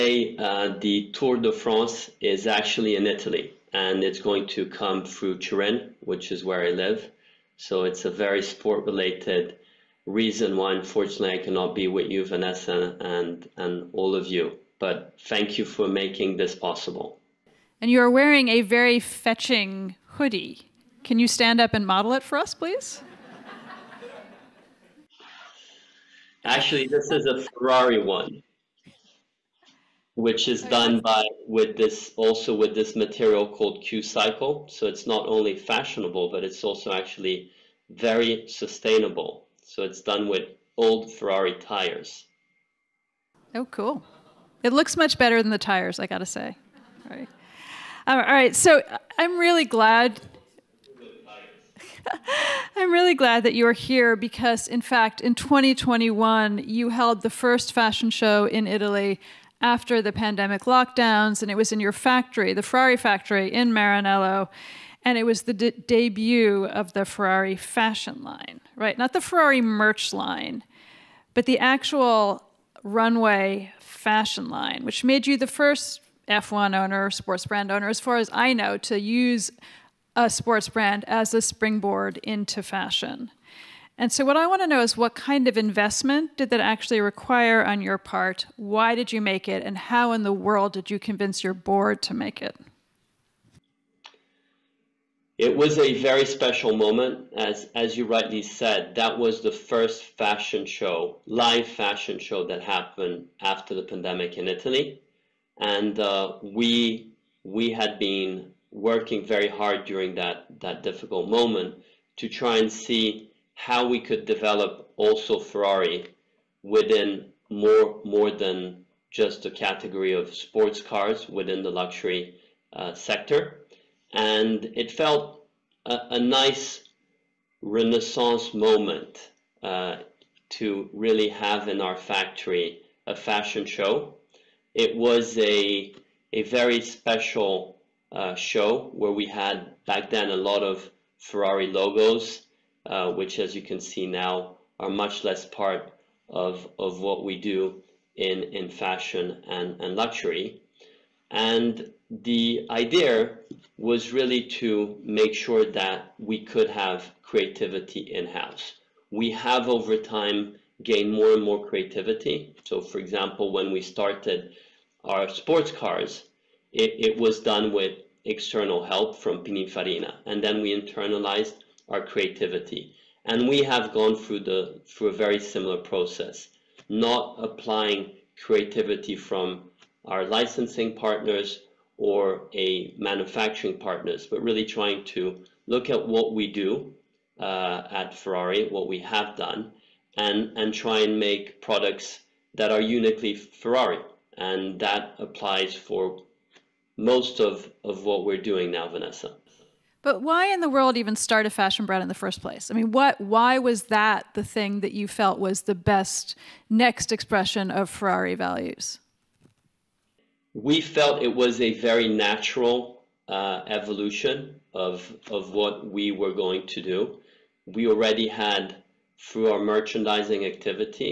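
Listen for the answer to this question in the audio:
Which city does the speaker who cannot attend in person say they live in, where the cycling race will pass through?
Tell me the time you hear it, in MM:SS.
00:05.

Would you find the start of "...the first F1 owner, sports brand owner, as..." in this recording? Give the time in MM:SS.
01:15.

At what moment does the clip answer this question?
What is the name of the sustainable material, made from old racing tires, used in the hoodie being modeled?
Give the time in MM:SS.
00:33.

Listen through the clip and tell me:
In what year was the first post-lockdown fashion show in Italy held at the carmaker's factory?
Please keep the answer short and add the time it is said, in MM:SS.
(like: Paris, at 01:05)
2021, at 00:55.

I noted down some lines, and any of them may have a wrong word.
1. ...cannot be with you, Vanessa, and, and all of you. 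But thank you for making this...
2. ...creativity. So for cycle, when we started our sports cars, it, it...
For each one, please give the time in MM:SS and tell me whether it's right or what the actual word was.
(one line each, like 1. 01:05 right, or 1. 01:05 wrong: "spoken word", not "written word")
1. 00:11 right
2. 02:41 wrong: "example", not "cycle".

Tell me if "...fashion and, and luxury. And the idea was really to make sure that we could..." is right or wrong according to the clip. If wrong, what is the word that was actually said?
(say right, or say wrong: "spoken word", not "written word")
right.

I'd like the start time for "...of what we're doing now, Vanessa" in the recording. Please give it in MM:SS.
03:17.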